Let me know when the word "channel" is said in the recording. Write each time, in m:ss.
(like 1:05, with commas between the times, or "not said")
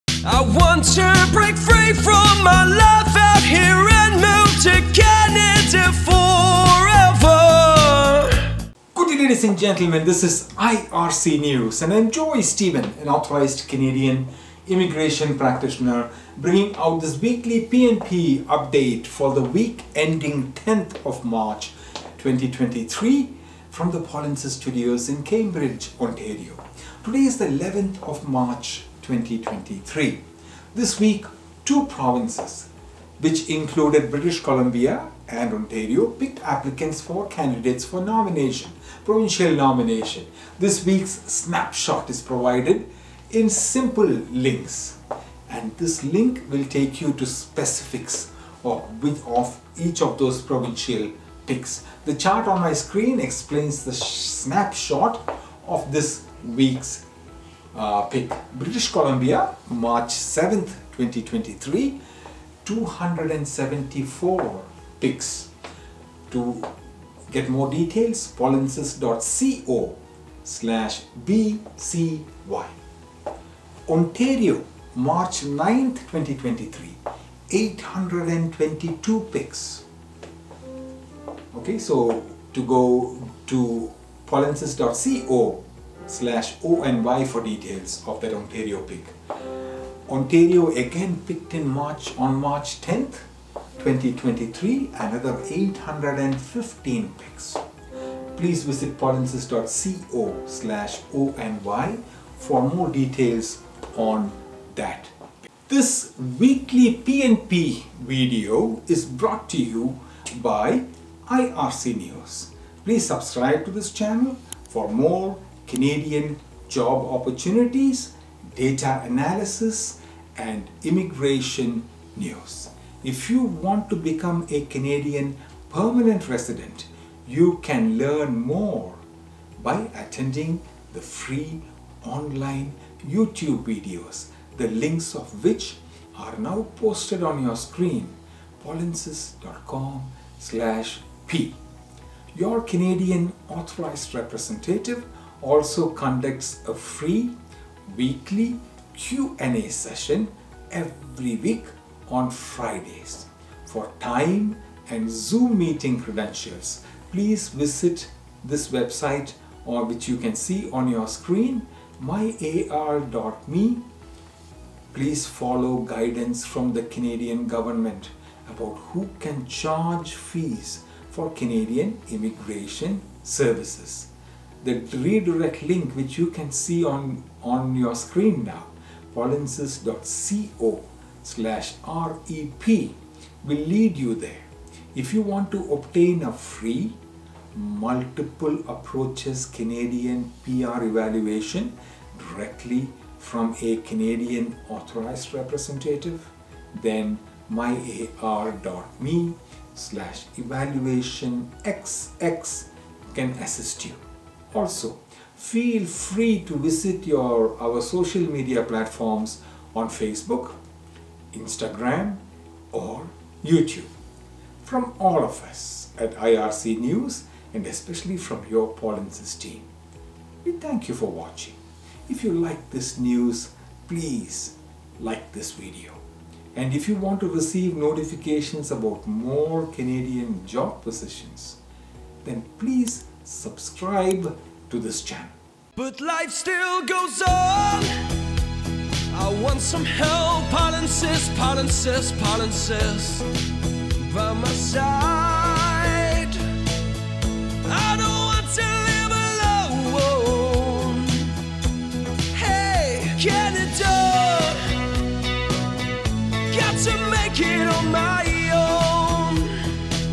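1:53, 3:55.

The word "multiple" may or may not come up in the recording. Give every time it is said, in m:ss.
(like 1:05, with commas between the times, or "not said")
3:07.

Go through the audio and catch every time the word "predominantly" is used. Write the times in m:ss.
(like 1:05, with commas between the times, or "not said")
not said.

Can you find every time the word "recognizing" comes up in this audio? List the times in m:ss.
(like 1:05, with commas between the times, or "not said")
not said.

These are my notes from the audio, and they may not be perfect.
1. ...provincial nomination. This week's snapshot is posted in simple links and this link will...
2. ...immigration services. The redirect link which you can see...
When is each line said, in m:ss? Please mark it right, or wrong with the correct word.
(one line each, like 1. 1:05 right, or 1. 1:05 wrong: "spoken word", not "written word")
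1. 0:39 wrong: "provided", not "posted"
2. 2:52 right.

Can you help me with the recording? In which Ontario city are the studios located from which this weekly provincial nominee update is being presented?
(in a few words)
Cambridge.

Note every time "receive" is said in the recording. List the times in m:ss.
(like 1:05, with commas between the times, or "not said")
3:47.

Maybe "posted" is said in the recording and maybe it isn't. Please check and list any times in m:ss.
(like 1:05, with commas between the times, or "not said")
2:16.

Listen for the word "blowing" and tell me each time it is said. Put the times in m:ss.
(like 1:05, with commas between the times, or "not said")
not said.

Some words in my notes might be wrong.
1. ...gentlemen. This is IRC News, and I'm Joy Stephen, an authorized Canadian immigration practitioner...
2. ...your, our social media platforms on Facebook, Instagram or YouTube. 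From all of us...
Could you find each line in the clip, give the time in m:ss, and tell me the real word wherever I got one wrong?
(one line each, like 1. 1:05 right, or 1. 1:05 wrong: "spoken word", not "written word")
1. 0:09 right
2. 3:27 right.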